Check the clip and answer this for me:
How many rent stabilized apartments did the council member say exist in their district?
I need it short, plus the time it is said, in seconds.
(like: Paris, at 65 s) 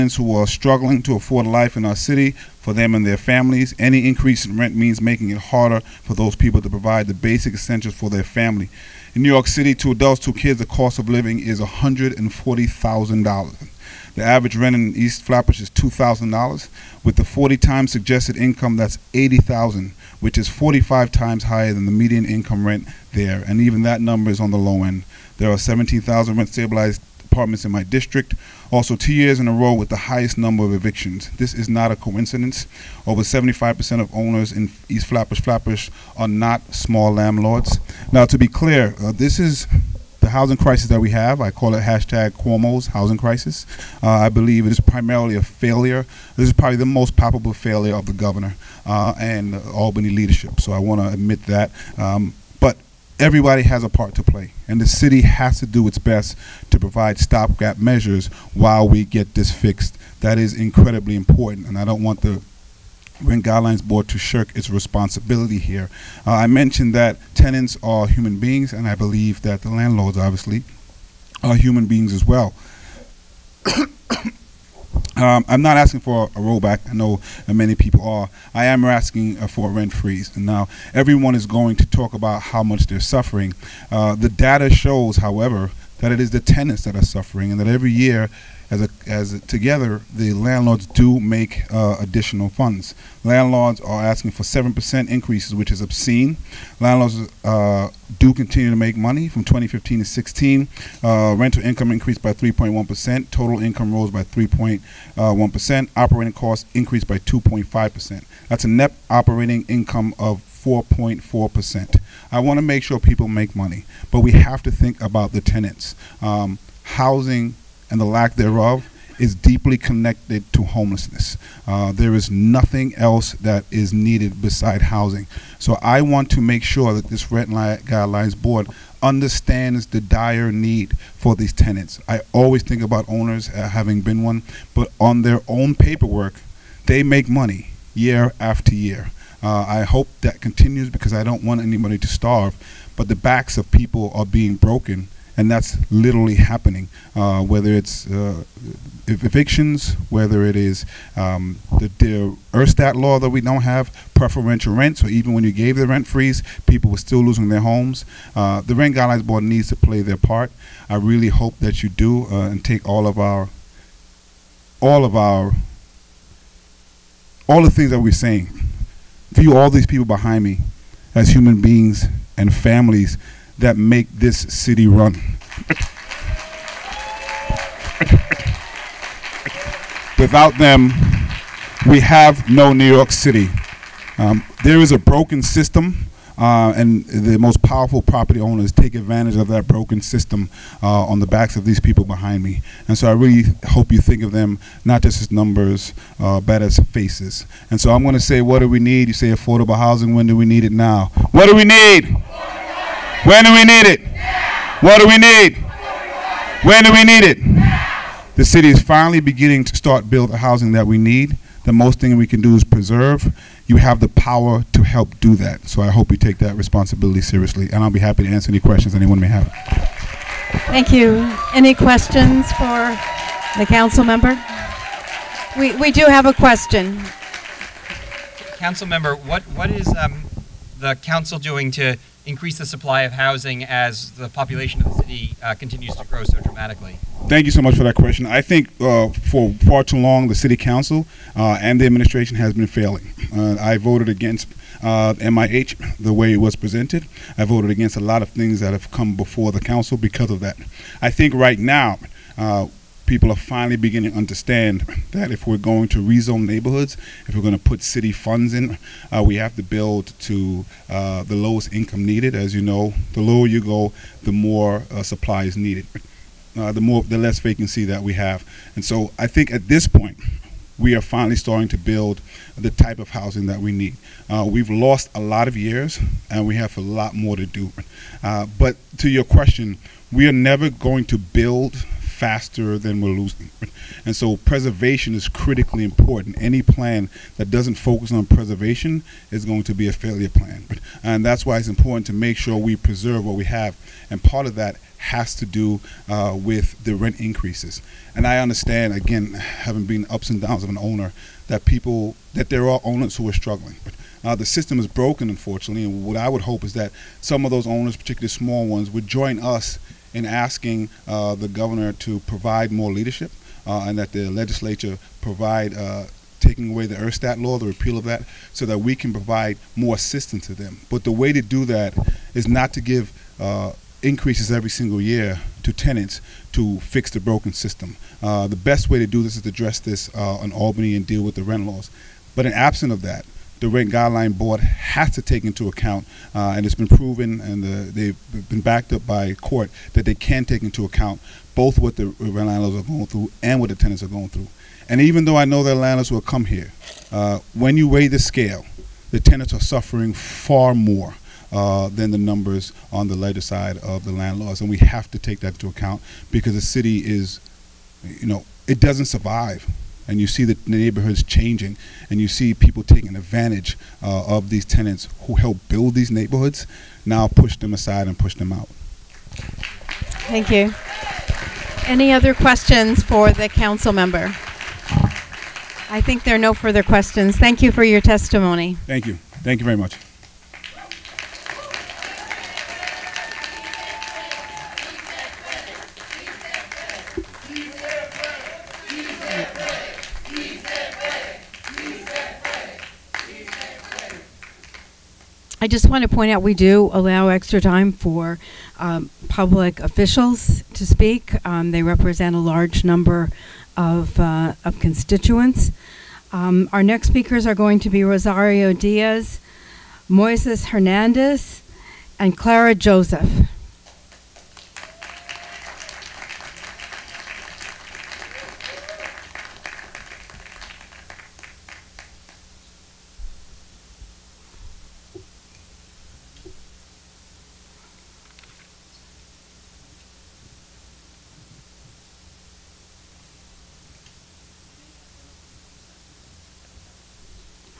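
17,000, at 25 s.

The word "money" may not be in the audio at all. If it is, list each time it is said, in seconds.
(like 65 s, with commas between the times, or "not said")
98 s, 113 s, 137 s.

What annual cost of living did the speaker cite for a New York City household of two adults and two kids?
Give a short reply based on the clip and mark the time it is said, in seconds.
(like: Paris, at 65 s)
$140,000, at 11 s.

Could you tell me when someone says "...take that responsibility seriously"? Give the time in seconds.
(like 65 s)
216 s.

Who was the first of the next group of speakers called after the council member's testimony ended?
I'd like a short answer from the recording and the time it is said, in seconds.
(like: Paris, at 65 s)
Rosario Diaz, at 408 s.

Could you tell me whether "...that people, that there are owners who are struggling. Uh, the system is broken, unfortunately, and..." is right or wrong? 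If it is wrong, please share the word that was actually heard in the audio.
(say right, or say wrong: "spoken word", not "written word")
right.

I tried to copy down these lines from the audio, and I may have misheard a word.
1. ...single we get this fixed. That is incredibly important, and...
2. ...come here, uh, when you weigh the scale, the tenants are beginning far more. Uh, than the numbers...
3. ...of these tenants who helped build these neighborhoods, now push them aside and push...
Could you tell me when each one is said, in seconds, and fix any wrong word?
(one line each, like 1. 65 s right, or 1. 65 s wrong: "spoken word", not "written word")
1. 58 s wrong: "while", not "single"
2. 346 s wrong: "suffering", not "beginning"
3. 364 s right.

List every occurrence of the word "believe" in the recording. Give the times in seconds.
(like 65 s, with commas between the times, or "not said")
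44 s, 68 s.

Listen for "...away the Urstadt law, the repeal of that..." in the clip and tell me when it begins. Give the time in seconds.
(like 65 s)
316 s.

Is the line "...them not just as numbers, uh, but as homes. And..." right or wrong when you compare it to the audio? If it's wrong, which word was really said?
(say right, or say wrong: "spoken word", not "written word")
wrong: "faces", not "homes".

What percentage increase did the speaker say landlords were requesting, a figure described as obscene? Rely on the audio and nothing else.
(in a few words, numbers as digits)
7 percent.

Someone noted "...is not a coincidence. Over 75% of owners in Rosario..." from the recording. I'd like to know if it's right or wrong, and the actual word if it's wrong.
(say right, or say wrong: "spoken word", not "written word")
wrong: "East", not "Rosario".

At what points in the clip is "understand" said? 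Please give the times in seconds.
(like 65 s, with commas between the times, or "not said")
129 s, 254 s, 298 s.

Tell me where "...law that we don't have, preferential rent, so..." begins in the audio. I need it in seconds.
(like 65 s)
152 s.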